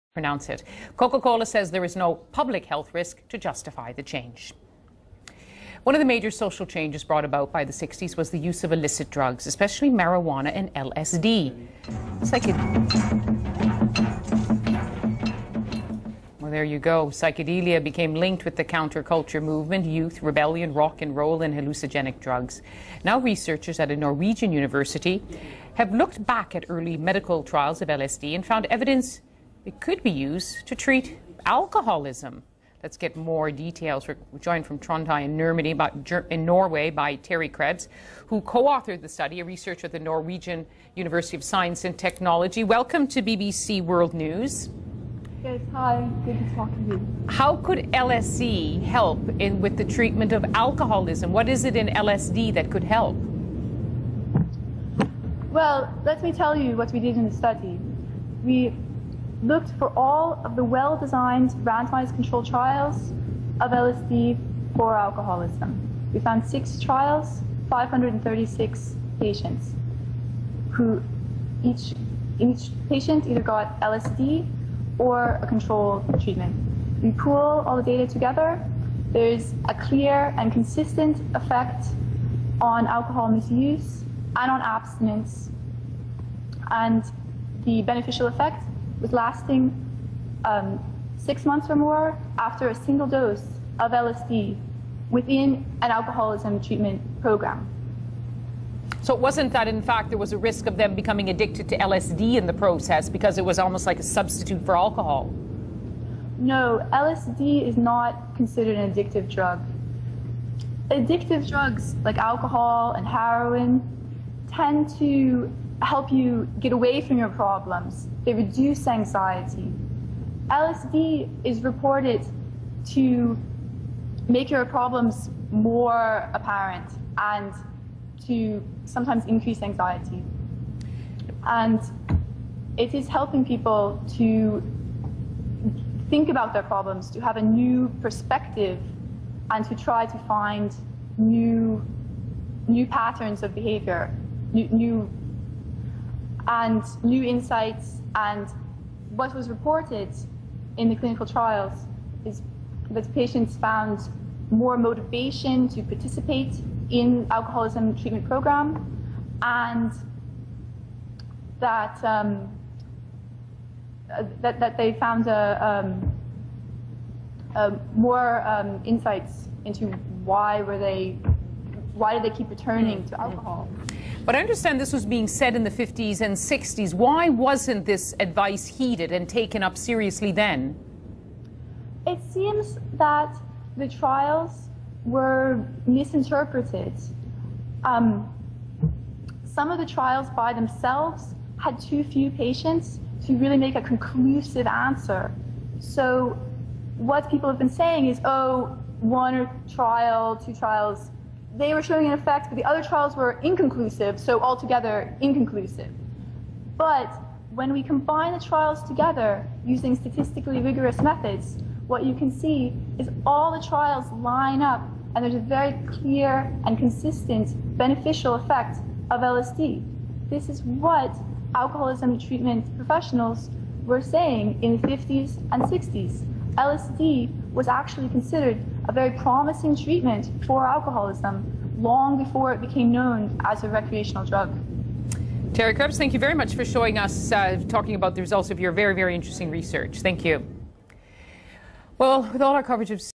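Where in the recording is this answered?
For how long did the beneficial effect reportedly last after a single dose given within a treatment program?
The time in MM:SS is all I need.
01:31.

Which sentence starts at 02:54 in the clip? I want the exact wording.
But I understand this was being said in the 50s and 60s.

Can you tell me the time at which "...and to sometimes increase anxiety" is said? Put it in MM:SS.
02:07.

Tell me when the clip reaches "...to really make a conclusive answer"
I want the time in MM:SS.
03:13.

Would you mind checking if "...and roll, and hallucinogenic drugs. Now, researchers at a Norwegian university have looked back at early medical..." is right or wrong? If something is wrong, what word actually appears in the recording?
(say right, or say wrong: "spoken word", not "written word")
right.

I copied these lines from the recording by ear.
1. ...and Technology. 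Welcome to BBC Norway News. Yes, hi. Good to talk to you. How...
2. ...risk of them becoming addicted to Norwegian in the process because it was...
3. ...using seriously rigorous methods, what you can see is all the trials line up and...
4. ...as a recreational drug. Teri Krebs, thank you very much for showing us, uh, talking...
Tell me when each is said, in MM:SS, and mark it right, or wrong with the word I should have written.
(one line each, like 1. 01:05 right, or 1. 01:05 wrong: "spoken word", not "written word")
1. 00:41 wrong: "World", not "Norway"
2. 01:40 wrong: "LSD", not "Norwegian"
3. 03:29 wrong: "statistically", not "seriously"
4. 03:53 right.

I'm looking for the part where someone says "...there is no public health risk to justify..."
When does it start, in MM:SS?
00:01.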